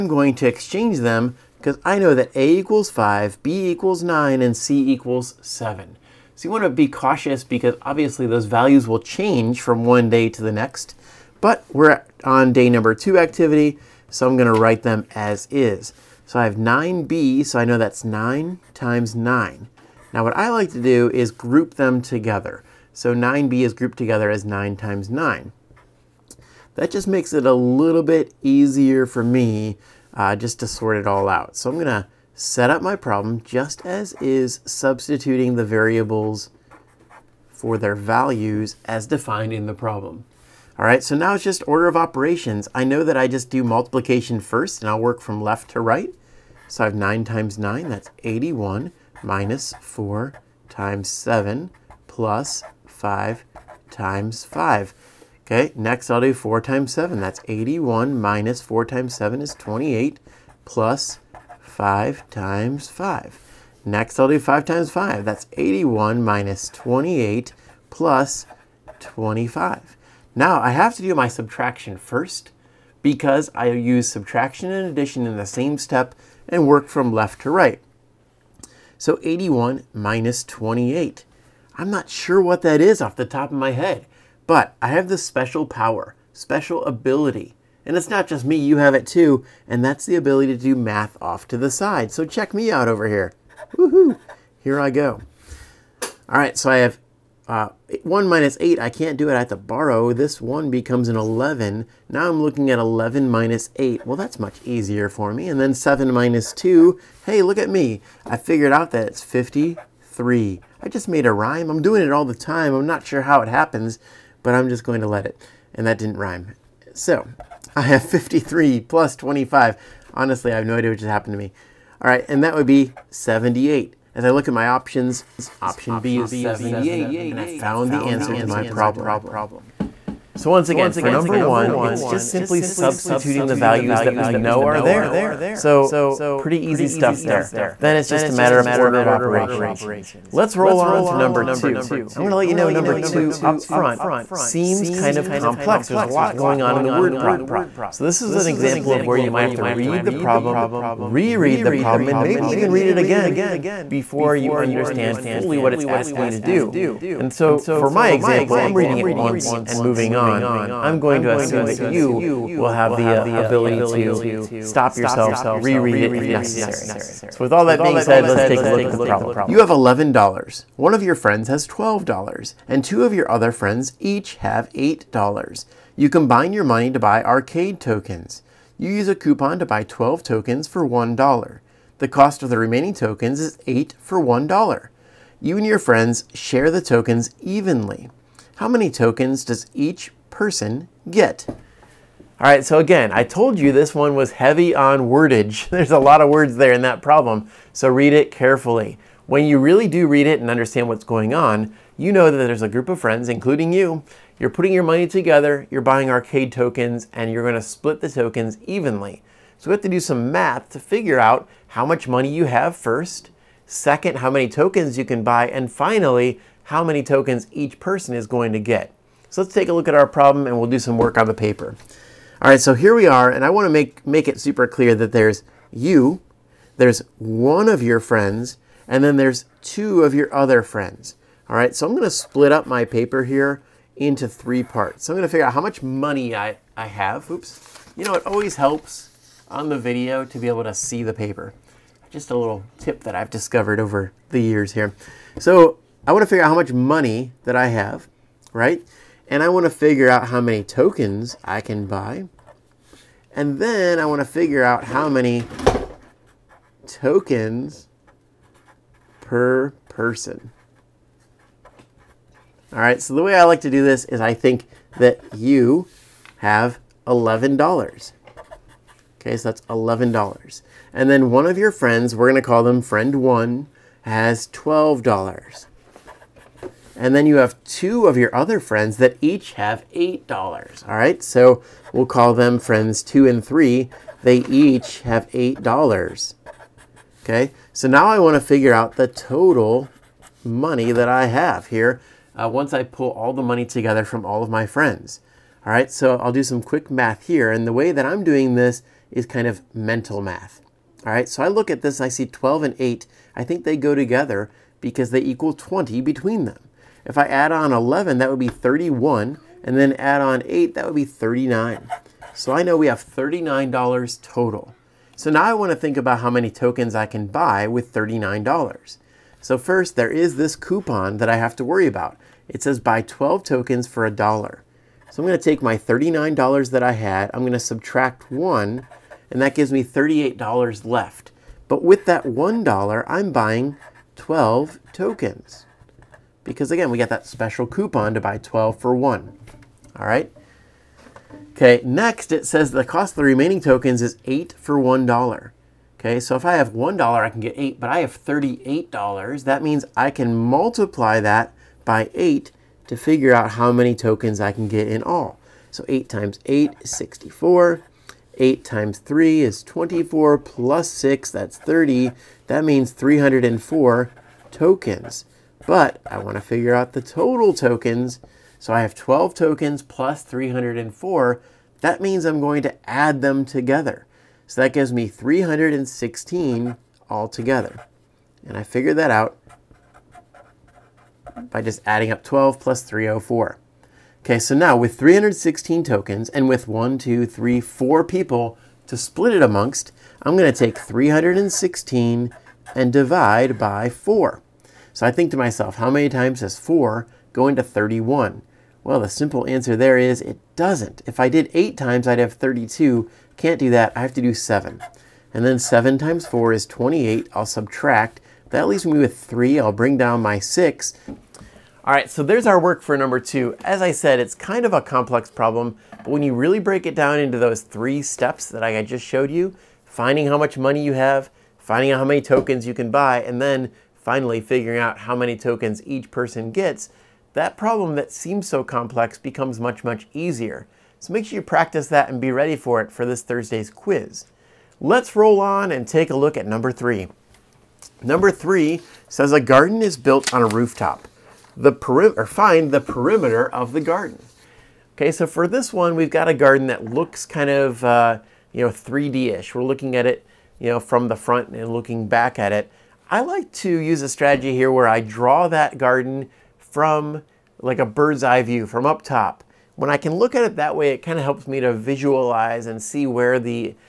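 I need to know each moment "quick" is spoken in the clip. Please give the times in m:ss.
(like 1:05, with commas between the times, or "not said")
4:56.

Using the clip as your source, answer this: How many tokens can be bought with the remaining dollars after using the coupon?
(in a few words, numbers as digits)
304.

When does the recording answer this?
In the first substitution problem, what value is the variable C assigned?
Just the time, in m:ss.
0:04.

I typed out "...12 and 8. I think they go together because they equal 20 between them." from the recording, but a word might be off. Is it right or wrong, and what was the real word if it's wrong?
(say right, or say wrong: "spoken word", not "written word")
right.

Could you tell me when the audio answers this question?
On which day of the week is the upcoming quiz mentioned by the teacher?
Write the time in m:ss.
7:13.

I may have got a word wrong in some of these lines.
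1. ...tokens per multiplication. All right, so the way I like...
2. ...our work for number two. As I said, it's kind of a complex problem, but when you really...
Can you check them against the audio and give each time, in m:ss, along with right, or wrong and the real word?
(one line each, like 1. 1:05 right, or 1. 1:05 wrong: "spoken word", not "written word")
1. 4:16 wrong: "person", not "multiplication"
2. 6:52 right.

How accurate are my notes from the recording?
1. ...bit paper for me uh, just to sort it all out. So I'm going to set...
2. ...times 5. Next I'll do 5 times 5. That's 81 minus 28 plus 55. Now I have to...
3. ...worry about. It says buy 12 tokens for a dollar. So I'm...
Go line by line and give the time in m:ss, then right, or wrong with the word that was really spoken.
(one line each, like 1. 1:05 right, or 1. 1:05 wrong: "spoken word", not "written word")
1. 0:28 wrong: "easier", not "paper"
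2. 1:02 wrong: "25", not "55"
3. 5:21 right.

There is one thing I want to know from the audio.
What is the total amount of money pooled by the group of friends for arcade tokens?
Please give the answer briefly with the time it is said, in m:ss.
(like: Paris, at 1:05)
$39, at 5:12.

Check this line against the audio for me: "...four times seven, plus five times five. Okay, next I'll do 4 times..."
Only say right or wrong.
right.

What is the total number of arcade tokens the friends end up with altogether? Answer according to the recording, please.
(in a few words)
316.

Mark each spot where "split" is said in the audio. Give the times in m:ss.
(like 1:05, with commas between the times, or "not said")
3:27, 3:52, 6:28.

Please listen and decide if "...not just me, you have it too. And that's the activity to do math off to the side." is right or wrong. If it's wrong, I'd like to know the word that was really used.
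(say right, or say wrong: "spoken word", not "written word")
wrong: "ability", not "activity".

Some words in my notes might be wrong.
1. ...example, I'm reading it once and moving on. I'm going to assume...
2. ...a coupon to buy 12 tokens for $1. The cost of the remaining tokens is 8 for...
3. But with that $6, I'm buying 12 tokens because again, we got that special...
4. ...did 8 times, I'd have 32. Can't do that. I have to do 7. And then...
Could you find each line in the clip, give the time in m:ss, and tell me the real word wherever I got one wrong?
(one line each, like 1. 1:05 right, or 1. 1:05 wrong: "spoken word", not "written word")
1. 2:38 right
2. 2:59 right
3. 5:31 wrong: "1", not "6"
4. 6:41 right.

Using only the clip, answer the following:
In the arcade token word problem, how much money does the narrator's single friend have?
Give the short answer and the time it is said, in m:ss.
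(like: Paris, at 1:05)
$12, at 2:50.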